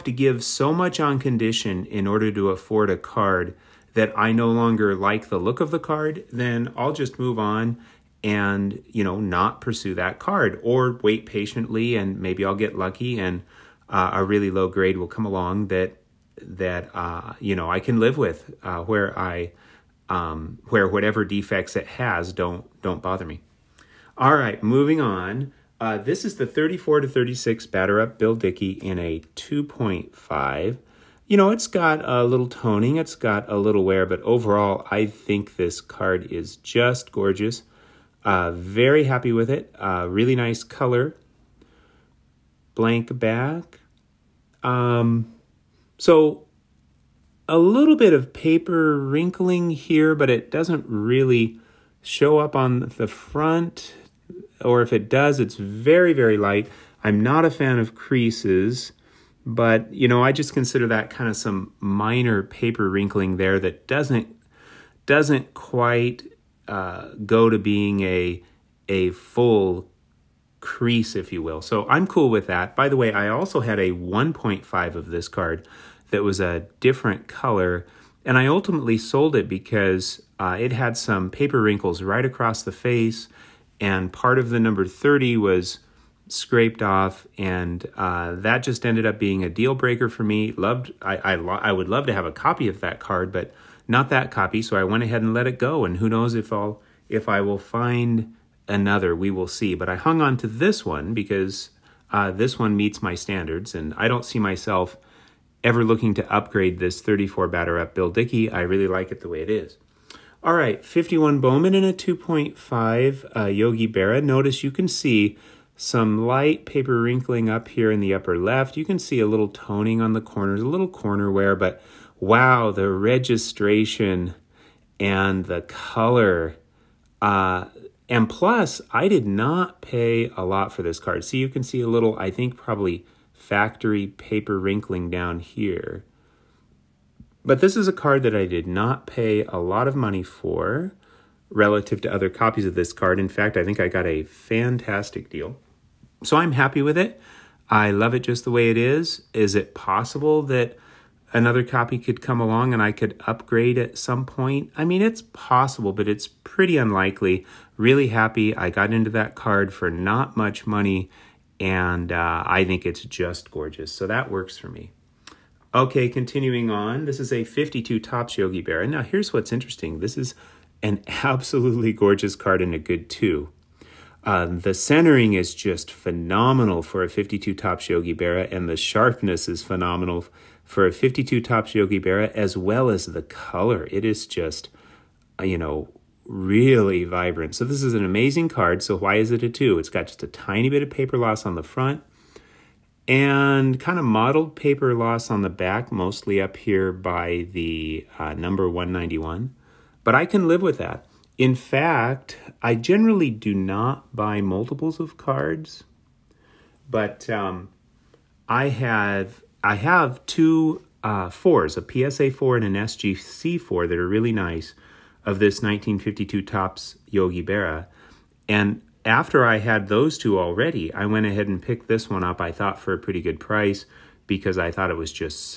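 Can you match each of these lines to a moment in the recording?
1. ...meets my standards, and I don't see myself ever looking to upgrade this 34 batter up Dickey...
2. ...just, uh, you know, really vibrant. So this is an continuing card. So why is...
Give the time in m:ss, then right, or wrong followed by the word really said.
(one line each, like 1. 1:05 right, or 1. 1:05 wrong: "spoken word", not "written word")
1. 1:42 wrong: "Bill", not "Dickey"
2. 3:04 wrong: "amazing", not "continuing".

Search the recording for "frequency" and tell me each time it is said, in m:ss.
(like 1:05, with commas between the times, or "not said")
not said.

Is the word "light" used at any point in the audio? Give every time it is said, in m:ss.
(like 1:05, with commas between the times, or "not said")
0:56, 1:56.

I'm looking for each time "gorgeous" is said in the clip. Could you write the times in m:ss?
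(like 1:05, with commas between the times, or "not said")
0:37, 2:43, 2:51.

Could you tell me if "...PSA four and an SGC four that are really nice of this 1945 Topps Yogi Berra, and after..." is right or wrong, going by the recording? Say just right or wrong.
wrong.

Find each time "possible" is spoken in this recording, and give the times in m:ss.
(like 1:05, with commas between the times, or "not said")
2:29, 2:35.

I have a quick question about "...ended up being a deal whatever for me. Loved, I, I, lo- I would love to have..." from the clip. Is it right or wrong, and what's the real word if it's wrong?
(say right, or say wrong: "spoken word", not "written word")
wrong: "breaker", not "whatever".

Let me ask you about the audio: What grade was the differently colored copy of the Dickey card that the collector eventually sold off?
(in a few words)
1.5.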